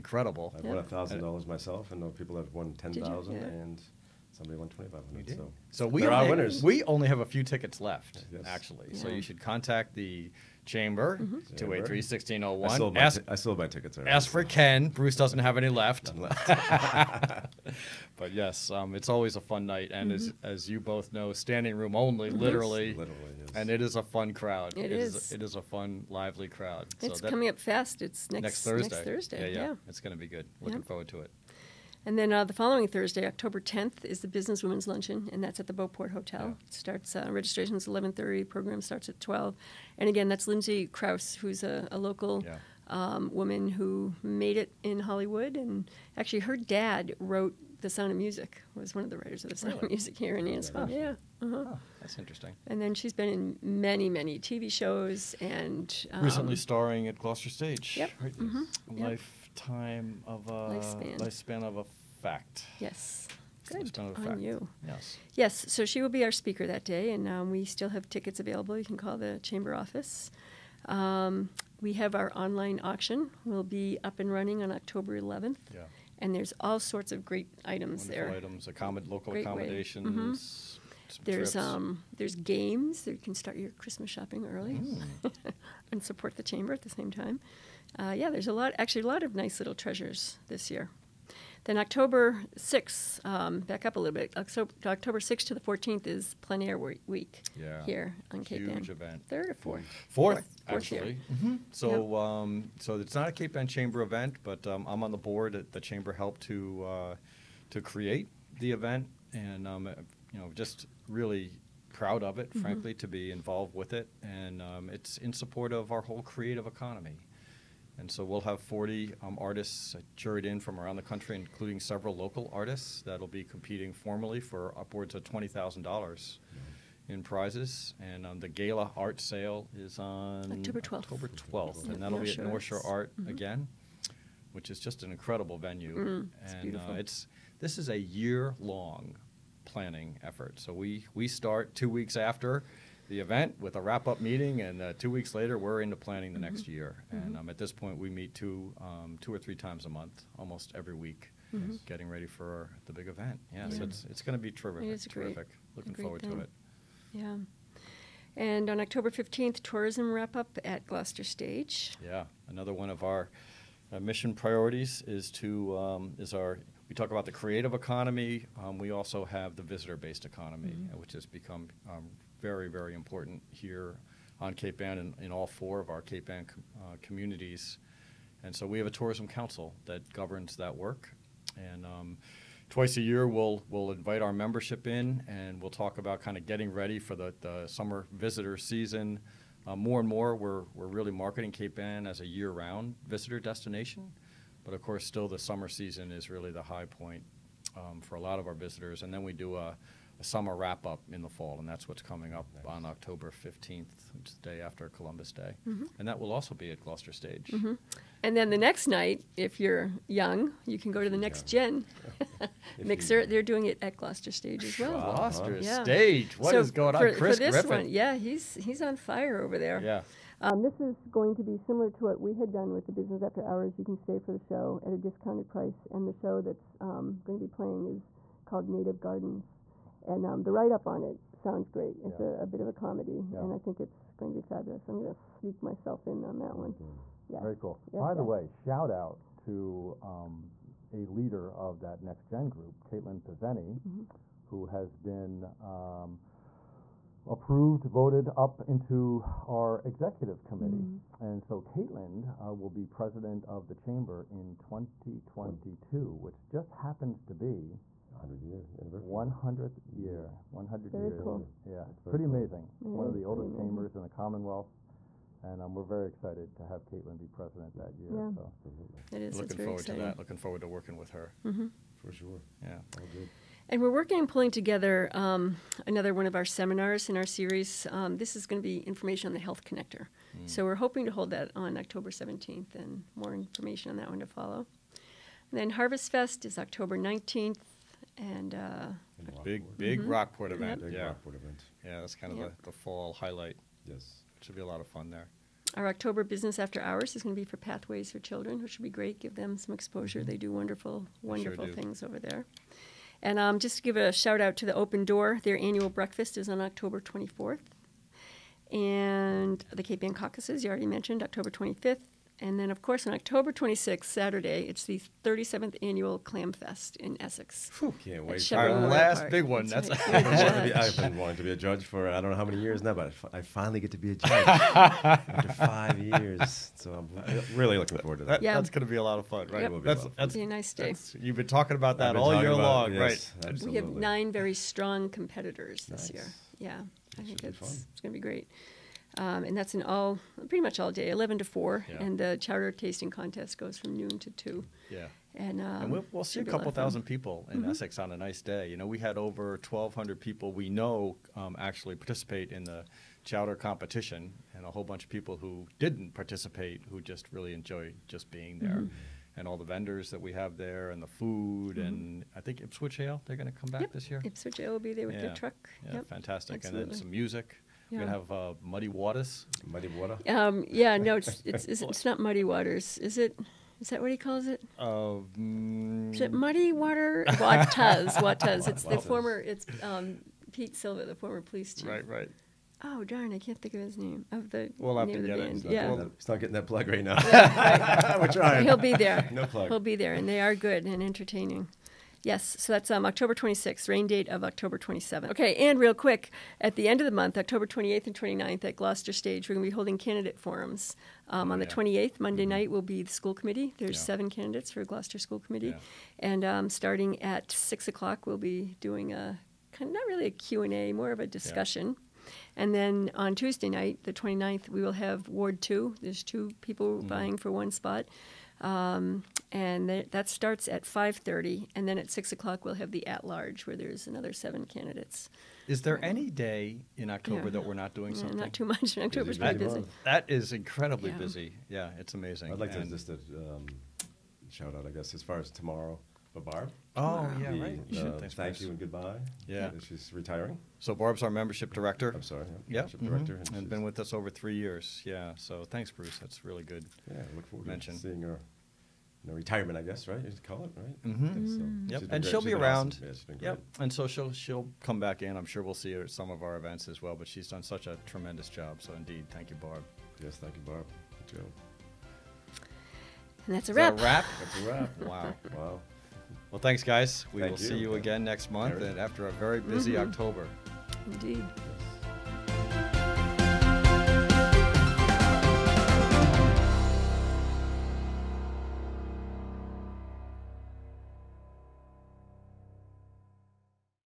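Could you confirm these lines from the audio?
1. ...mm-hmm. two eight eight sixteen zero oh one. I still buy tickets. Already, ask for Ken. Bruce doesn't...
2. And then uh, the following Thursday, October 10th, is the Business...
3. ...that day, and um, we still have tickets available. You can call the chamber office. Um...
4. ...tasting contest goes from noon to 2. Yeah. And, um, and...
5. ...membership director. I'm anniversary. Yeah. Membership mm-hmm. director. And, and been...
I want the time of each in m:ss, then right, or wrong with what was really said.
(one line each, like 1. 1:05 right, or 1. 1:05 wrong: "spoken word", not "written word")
1. 0:11 wrong: "three", not "eight"
2. 0:32 right
3. 1:06 right
4. 5:42 right
5. 7:21 wrong: "sorry", not "anniversary".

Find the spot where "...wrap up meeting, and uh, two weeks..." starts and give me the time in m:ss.
2:23.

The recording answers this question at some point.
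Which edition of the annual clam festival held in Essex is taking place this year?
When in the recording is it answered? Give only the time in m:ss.
5:15.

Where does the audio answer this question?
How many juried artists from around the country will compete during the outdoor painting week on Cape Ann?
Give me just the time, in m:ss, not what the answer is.
1:58.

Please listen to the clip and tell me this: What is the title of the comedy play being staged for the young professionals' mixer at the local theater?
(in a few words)
Native Gardens.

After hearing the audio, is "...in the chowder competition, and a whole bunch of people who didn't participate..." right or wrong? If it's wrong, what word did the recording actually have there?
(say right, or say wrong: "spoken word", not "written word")
right.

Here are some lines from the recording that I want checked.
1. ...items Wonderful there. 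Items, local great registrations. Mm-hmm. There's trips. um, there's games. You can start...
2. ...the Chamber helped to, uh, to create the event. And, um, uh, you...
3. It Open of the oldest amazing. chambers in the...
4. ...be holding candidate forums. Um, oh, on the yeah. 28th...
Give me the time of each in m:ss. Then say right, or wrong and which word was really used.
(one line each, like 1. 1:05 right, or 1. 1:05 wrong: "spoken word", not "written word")
1. 1:17 wrong: "accommodations", not "registrations"
2. 1:45 right
3. 4:22 wrong: "One", not "Open"
4. 6:39 right.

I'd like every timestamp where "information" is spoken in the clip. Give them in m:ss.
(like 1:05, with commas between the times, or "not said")
4:38, 4:43.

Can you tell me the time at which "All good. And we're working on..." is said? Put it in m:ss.
4:32.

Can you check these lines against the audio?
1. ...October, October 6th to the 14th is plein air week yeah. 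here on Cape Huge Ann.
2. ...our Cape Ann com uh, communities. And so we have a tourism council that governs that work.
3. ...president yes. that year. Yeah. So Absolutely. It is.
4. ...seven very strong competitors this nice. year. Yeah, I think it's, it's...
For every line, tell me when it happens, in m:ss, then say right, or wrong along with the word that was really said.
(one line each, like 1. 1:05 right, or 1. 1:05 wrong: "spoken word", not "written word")
1. 1:34 right
2. 2:55 right
3. 4:27 right
4. 5:33 wrong: "nine", not "seven".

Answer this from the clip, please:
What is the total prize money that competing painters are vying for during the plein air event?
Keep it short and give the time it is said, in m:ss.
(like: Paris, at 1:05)
$20,000, at 2:05.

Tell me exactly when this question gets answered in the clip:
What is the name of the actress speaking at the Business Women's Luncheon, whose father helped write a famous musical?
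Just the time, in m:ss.
0:40.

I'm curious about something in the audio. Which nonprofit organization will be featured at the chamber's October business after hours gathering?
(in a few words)
Pathways for Children.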